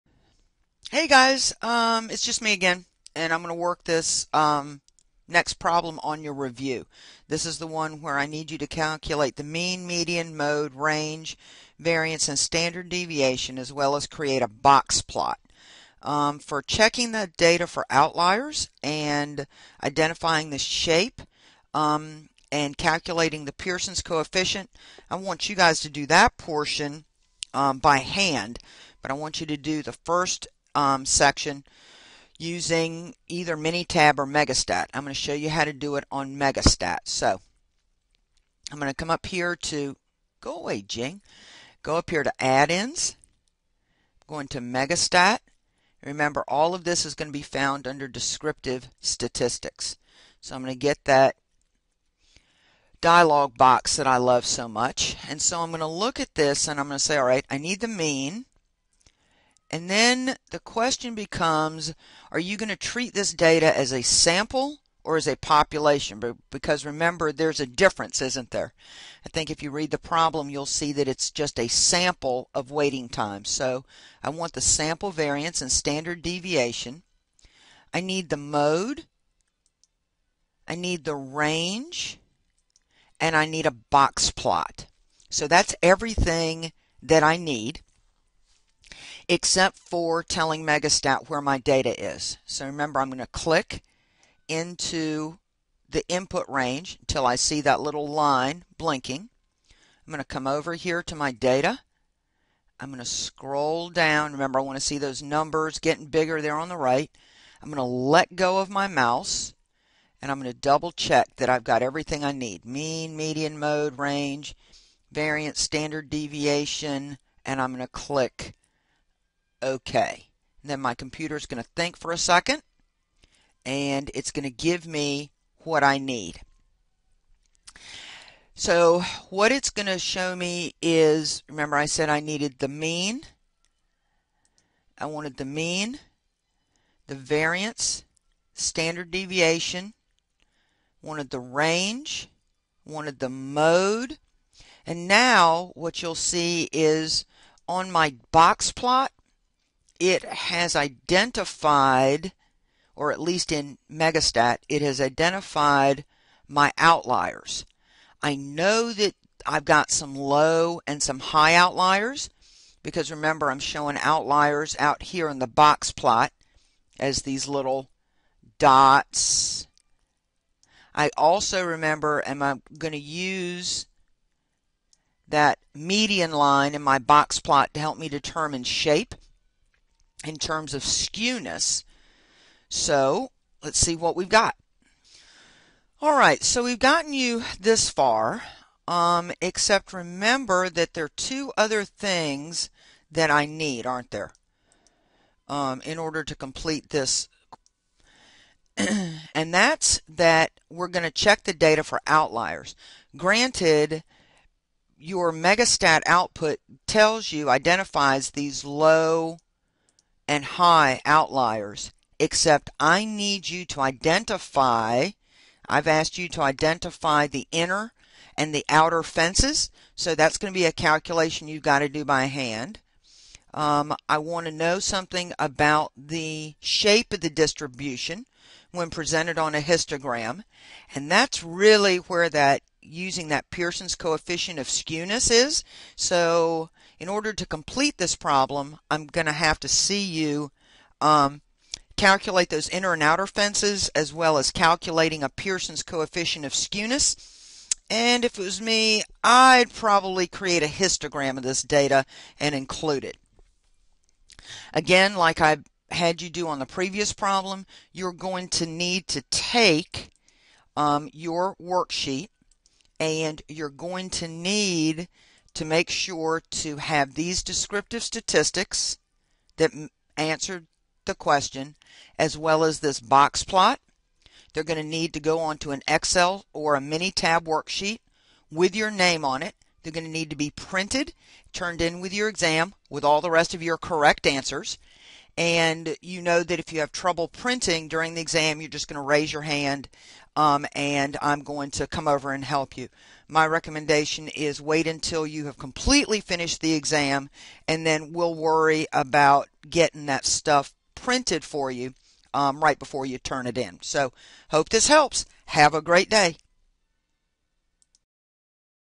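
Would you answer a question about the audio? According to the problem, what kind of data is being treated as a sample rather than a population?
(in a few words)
waiting time.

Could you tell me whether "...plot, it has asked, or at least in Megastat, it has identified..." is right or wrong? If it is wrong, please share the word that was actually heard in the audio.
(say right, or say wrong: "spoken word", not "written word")
wrong: "identified", not "asked".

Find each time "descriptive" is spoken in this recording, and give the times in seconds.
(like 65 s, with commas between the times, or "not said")
48 s, 267 s.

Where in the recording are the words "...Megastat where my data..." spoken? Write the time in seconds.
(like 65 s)
90 s.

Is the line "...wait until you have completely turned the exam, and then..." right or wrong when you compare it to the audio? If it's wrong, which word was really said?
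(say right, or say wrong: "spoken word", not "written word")
wrong: "finished", not "turned".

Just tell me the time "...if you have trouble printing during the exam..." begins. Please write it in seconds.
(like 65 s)
286 s.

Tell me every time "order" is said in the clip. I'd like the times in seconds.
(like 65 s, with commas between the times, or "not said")
195 s, 237 s.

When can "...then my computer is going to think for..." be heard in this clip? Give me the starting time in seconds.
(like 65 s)
120 s.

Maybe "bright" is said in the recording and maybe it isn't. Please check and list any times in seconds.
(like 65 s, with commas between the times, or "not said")
not said.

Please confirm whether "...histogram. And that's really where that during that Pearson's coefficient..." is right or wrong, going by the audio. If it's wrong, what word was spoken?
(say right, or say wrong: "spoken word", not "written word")
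wrong: "using", not "during".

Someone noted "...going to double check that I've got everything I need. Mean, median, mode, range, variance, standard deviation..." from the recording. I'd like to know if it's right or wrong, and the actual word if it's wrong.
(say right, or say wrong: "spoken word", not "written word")
right.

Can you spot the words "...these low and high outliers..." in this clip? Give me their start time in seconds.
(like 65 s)
208 s.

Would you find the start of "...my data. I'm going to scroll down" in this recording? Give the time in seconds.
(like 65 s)
101 s.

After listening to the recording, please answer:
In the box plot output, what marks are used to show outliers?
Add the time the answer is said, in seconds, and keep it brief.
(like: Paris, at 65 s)
little dots, at 167 s.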